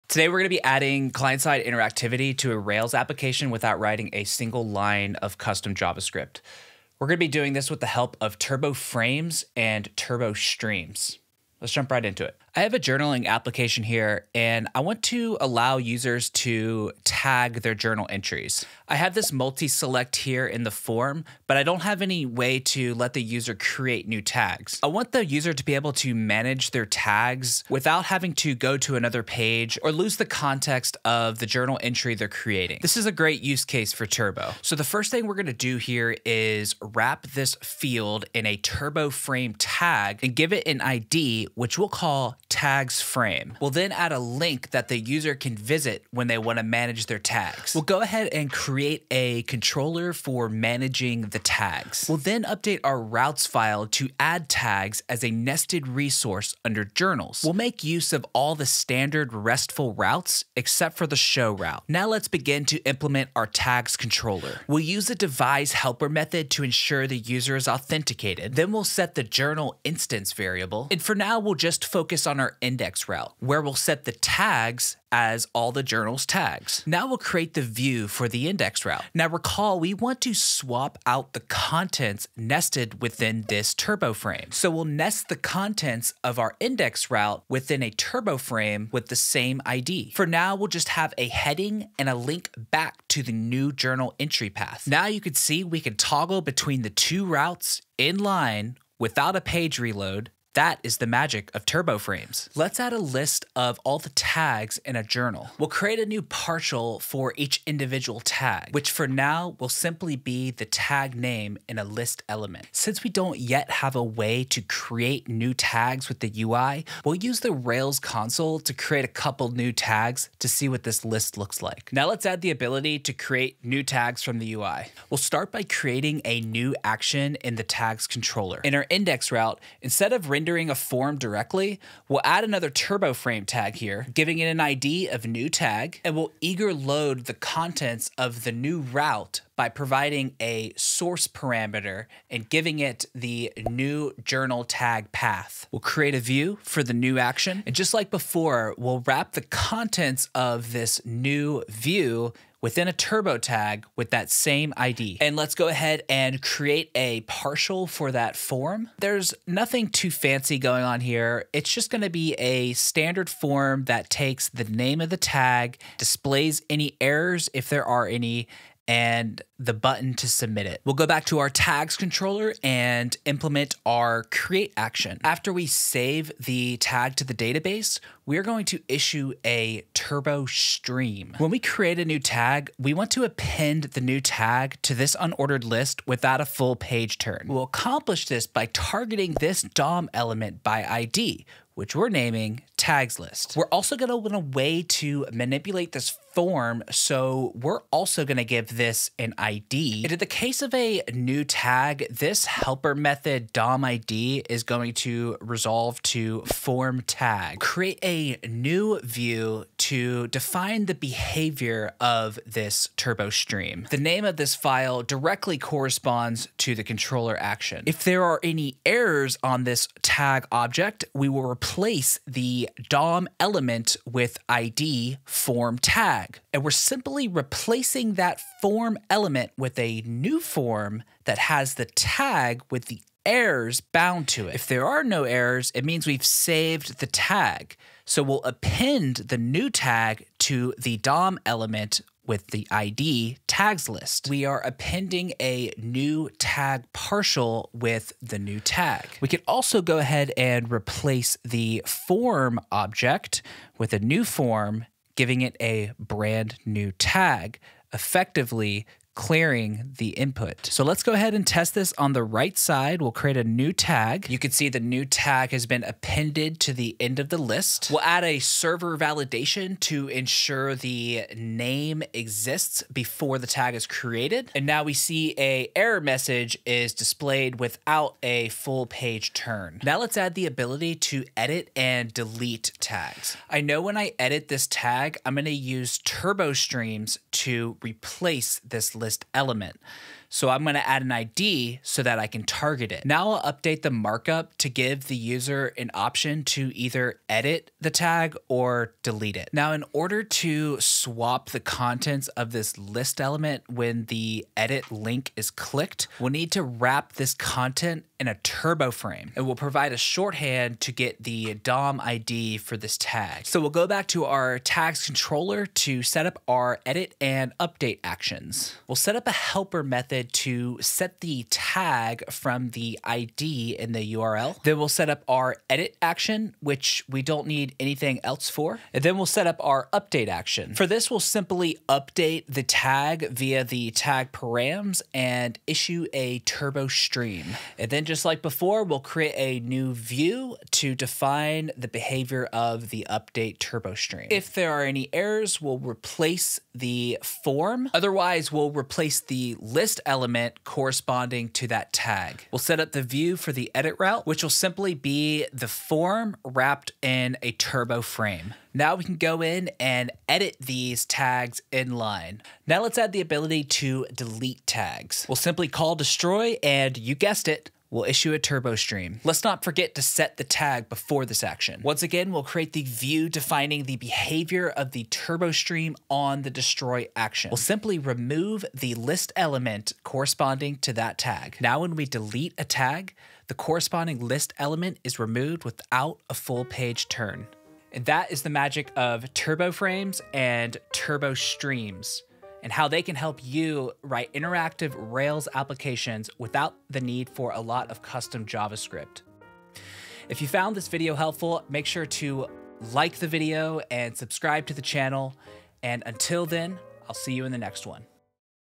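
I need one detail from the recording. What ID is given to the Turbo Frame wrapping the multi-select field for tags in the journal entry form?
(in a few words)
tags frame.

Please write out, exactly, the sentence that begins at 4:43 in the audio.
I know when I edit this tag, I'm gonna use Turbo Streams to replace this list element.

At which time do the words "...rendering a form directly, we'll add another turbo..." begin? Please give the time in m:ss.
2:10.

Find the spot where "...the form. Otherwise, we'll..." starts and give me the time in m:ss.
5:46.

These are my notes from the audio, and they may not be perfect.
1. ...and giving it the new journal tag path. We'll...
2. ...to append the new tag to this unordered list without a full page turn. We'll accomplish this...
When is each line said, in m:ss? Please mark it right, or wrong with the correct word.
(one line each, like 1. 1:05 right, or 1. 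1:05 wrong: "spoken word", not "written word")
1. 2:22 right
2. 3:03 right.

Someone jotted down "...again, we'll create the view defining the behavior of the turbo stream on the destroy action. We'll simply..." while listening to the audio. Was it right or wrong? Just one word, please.
right.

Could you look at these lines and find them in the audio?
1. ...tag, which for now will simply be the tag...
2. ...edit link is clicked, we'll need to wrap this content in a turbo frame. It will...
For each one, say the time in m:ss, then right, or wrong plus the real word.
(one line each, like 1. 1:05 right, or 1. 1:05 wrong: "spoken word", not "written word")
1. 1:48 right
2. 5:04 right.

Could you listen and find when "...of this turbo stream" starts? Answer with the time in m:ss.
3:31.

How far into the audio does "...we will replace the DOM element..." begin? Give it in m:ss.
3:41.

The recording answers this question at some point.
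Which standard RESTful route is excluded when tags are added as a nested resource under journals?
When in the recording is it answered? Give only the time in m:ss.
1:01.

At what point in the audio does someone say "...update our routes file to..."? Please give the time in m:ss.
0:52.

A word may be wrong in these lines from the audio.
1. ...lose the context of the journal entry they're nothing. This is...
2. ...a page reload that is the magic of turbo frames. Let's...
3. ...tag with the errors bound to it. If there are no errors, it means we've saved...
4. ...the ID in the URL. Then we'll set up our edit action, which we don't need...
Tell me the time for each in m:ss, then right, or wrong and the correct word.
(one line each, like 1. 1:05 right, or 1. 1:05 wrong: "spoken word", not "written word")
1. 0:29 wrong: "creating", not "nothing"
2. 1:39 right
3. 3:51 right
4. 5:22 right.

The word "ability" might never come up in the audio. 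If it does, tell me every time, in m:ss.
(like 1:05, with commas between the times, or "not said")
2:02, 4:40, 6:03.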